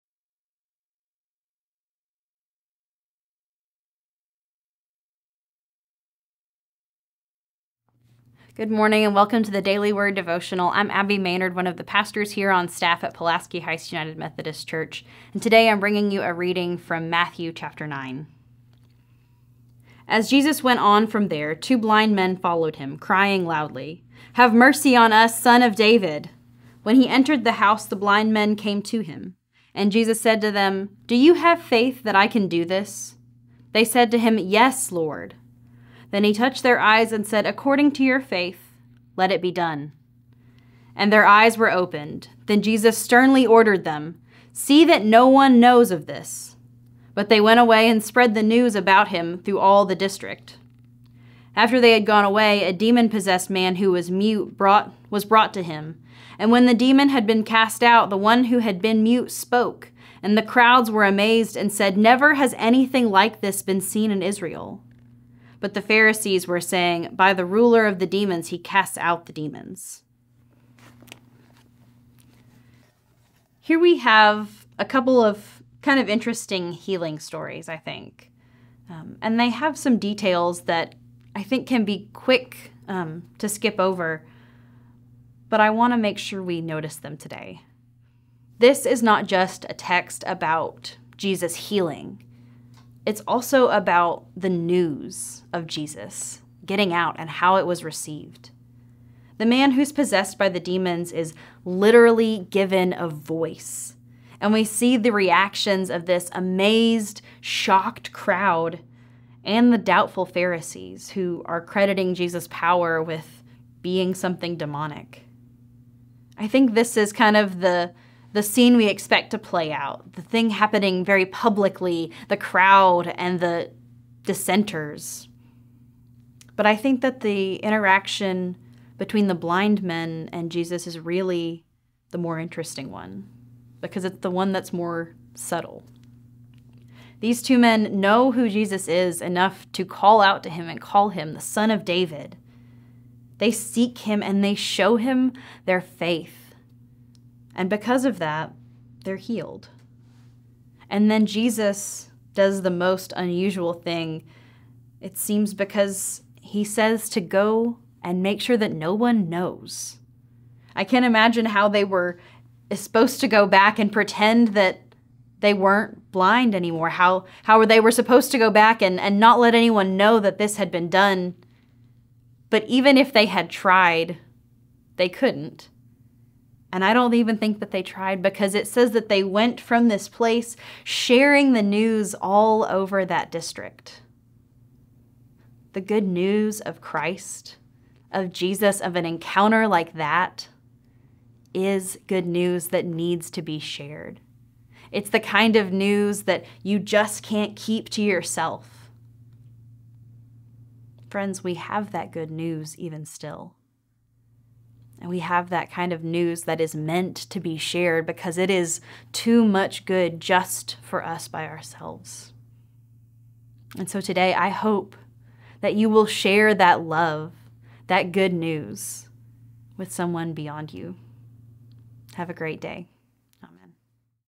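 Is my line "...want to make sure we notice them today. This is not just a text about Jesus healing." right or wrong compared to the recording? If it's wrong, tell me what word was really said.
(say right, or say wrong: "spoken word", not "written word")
right.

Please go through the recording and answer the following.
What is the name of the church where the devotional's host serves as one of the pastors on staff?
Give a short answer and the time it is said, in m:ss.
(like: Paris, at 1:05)
Pulaski Heights United Methodist Church, at 0:13.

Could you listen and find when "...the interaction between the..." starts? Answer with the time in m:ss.
2:07.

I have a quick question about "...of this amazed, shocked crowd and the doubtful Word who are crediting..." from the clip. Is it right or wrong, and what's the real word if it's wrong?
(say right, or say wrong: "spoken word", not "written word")
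wrong: "Pharisees", not "Word".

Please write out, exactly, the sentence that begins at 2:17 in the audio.
These two men know who Jesus is enough to call out to him and call him the Son of David.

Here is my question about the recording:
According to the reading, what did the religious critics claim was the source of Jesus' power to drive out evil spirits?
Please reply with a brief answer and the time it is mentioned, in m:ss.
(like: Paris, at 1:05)
The ruler of the demons, at 1:07.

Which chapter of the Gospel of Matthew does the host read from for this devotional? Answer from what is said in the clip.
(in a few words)
9.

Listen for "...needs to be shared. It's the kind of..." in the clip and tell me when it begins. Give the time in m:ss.
3:12.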